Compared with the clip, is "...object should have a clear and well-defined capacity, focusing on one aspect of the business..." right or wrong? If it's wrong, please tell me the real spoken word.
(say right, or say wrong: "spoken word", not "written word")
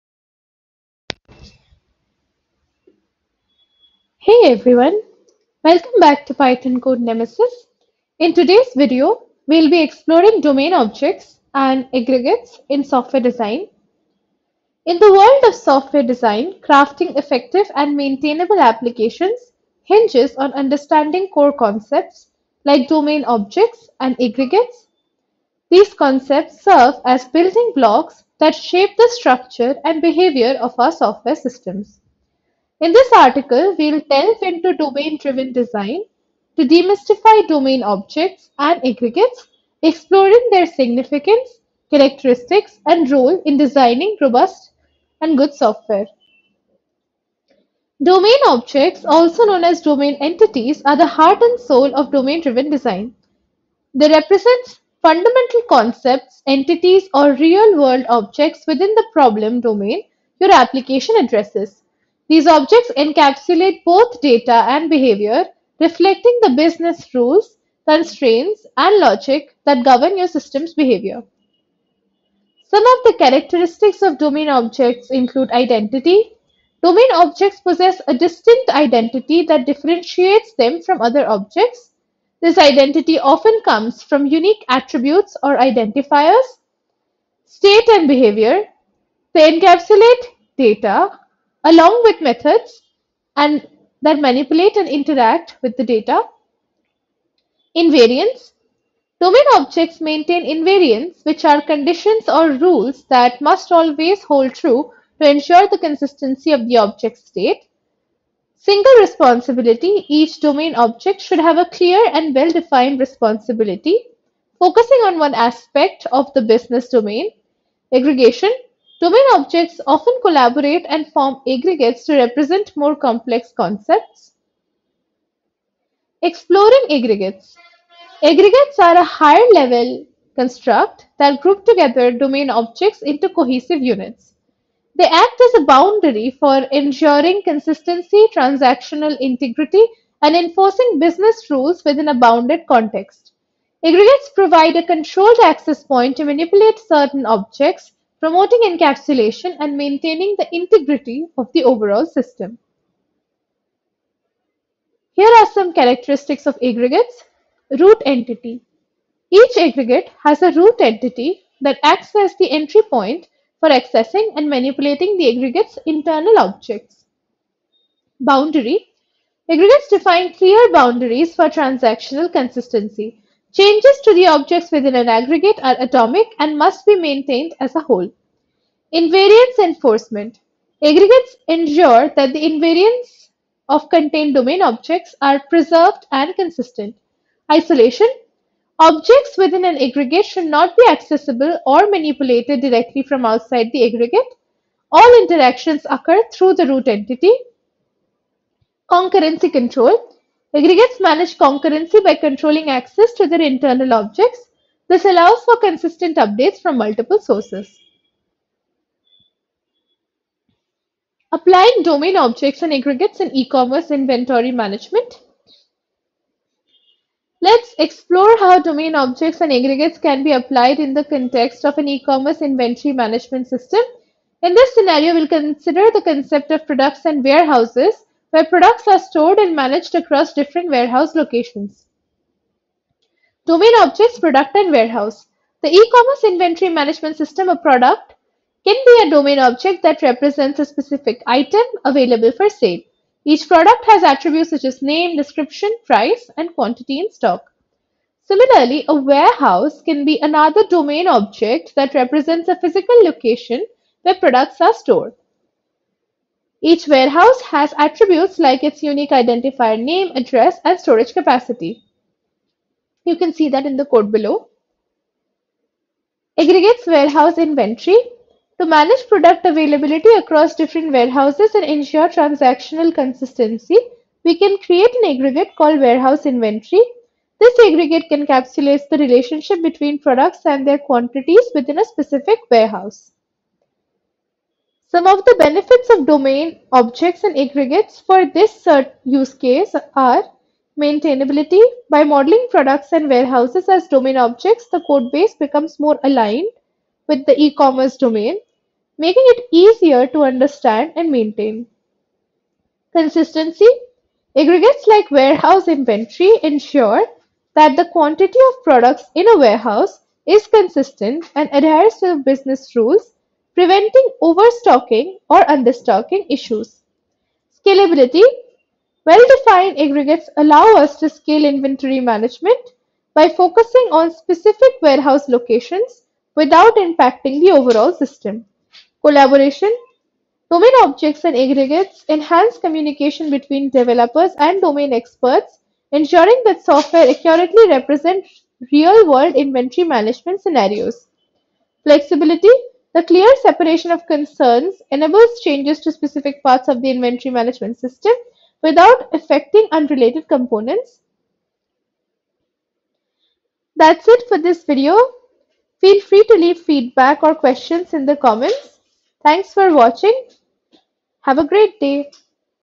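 wrong: "responsibility", not "capacity".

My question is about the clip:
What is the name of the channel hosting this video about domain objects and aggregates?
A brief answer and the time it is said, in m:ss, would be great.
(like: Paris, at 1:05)
Python Code Nemesis, at 0:06.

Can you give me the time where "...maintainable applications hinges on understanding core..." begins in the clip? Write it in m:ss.
0:17.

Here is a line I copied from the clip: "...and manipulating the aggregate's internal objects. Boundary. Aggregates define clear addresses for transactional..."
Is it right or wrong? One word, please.
wrong.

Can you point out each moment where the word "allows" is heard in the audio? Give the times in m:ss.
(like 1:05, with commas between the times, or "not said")
3:25, 5:20.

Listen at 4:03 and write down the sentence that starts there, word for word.
Each product has attributes such as name, description, price, and quantity in stock.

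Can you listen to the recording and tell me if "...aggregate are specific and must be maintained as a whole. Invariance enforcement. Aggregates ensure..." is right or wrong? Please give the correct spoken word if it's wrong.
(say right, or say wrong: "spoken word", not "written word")
wrong: "atomic", not "specific".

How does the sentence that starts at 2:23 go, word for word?
Aggregates provide a controlled access point to manipulate certain objects promoting encapsulation and maintaining the integrity of the overall system.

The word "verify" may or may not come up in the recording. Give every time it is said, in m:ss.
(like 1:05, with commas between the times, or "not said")
not said.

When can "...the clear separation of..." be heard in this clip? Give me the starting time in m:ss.
5:42.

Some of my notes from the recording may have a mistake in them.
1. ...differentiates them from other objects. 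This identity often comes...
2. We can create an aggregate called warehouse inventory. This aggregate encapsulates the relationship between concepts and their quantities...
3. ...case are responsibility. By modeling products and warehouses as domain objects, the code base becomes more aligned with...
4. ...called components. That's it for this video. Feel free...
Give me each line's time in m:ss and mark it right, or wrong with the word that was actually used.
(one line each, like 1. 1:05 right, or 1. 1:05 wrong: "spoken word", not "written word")
1. 1:19 right
2. 4:34 wrong: "products", not "concepts"
3. 4:49 wrong: "maintainability", not "responsibility"
4. 5:49 wrong: "unrelated", not "called".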